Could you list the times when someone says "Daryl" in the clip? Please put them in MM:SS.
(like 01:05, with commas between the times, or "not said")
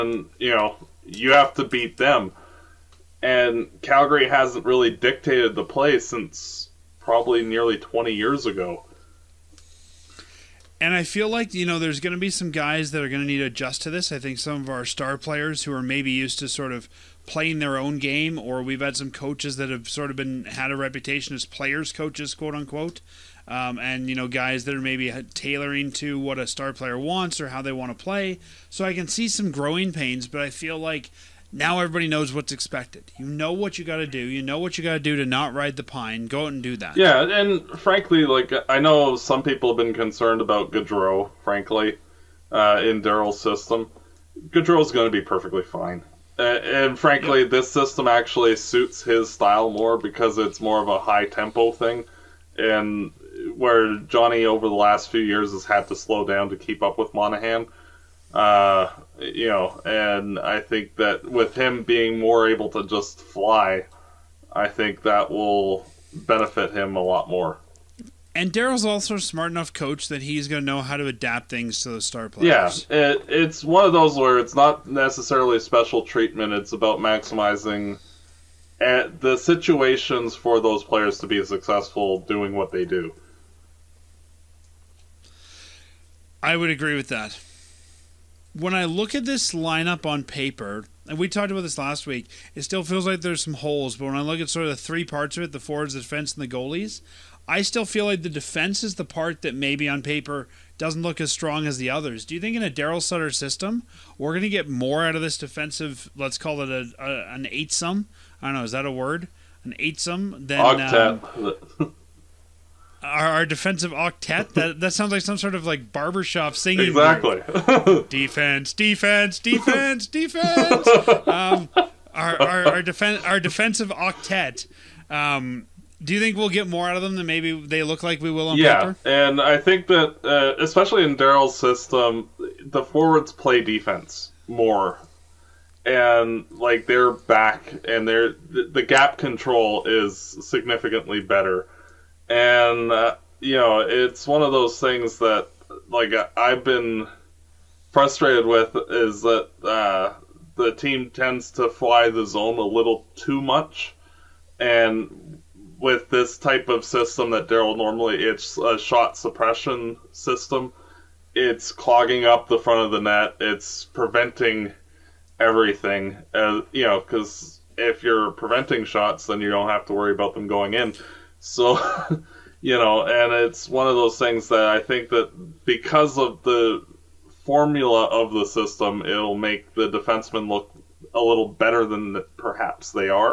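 00:43, 01:08, 01:42, 02:11, 02:37.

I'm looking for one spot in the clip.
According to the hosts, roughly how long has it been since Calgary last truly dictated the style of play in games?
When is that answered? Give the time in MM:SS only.
00:07.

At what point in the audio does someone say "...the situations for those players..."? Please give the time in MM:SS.
01:19.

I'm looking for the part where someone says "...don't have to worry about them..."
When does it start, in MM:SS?
02:49.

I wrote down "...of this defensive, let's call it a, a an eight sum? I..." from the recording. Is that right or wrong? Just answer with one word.
right.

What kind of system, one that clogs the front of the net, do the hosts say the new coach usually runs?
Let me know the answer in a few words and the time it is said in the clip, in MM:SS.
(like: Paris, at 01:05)
shot suppression system, at 02:38.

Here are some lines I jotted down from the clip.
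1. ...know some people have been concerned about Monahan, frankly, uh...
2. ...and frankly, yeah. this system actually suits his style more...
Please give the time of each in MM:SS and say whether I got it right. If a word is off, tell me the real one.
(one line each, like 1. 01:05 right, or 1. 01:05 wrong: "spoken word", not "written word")
1. 00:38 wrong: "Gaudreau", not "Monahan"
2. 00:46 right.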